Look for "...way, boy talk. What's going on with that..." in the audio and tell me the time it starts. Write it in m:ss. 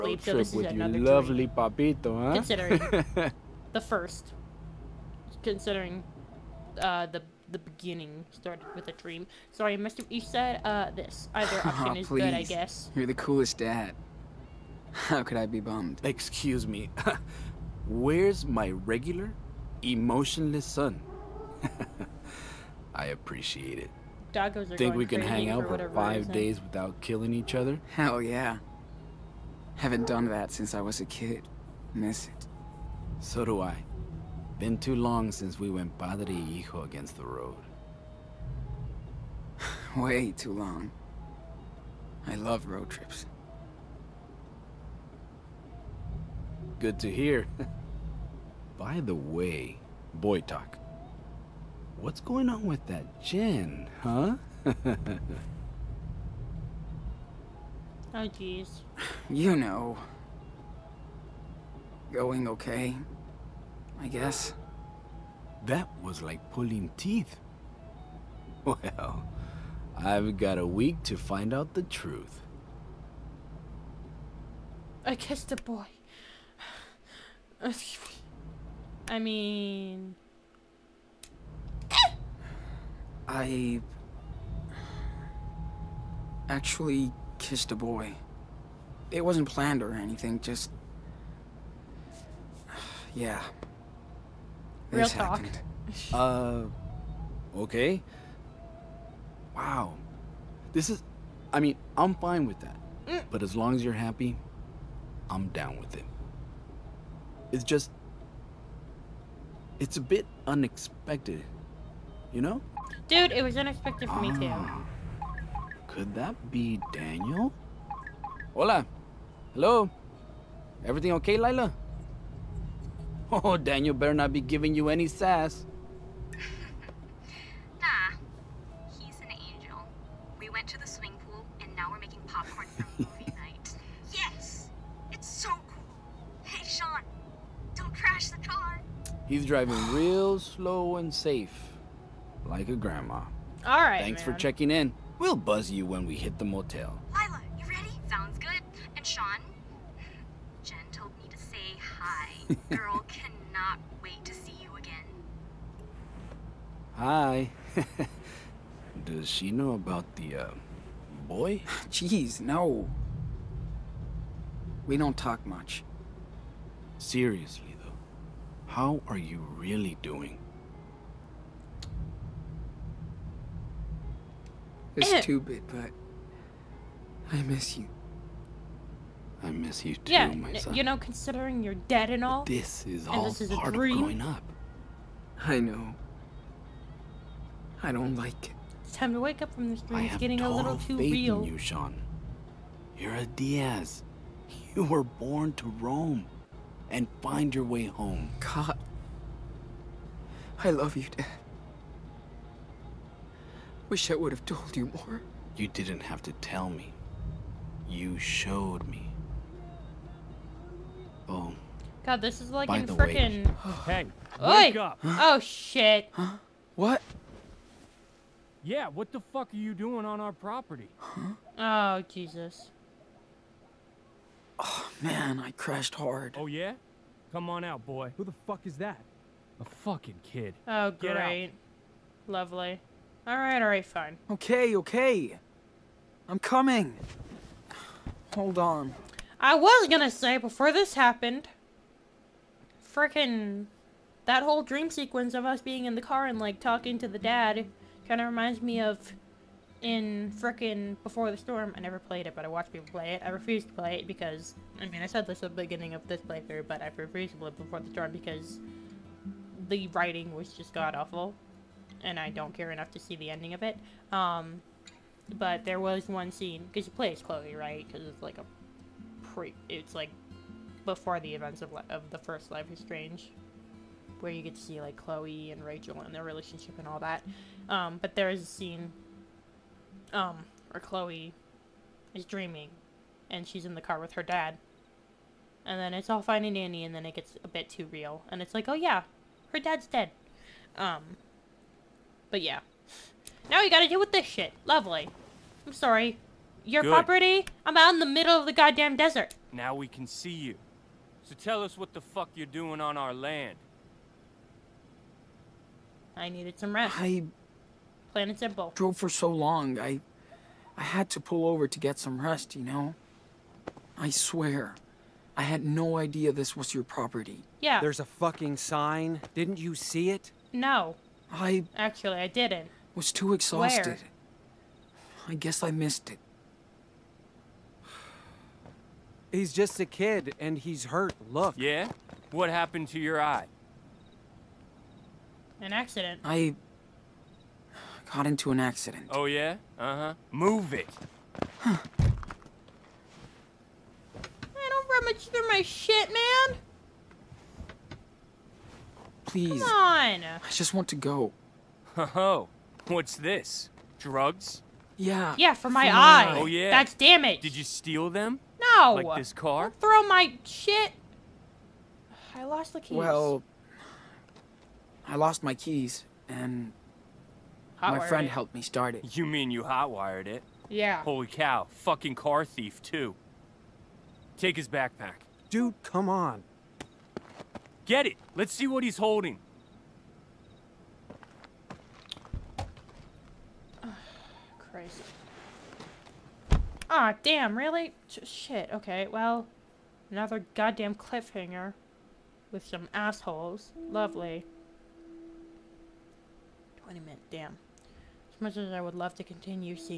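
0:49.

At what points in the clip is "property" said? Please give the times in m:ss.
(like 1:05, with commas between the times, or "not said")
3:40, 4:56, 5:16.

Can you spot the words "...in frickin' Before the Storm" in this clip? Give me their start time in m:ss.
4:09.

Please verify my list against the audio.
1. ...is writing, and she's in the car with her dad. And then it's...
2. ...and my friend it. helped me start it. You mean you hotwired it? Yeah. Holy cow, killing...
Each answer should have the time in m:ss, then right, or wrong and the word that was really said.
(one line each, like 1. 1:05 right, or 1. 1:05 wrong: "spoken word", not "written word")
1. 4:42 wrong: "dreaming", not "writing"
2. 6:06 wrong: "fucking", not "killing".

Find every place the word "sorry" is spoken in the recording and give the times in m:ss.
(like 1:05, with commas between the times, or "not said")
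0:09, 4:55.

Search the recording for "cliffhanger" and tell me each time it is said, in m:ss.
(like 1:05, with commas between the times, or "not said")
6:30.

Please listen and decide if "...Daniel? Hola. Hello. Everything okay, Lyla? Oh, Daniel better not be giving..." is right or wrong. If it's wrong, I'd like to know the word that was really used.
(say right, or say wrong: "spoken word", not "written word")
right.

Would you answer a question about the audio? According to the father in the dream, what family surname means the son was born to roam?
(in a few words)
Diaz.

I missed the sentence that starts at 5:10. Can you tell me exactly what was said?
I had to pull over to get some rest, you know?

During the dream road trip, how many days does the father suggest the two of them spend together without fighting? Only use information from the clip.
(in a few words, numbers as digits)
5.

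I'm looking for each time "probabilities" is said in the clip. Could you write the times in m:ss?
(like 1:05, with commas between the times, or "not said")
not said.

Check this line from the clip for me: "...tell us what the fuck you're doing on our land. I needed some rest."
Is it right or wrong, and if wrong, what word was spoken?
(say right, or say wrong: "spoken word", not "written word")
right.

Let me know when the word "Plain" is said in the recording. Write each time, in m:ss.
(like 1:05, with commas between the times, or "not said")
5:08.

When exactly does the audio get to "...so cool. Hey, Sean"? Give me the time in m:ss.
2:15.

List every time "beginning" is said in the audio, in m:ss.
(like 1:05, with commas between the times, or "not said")
0:07, 4:15.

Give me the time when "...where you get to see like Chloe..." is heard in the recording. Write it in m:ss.
4:34.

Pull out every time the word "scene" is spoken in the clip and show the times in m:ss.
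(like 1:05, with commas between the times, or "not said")
4:26, 4:38.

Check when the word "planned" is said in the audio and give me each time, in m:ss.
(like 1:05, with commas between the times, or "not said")
1:29.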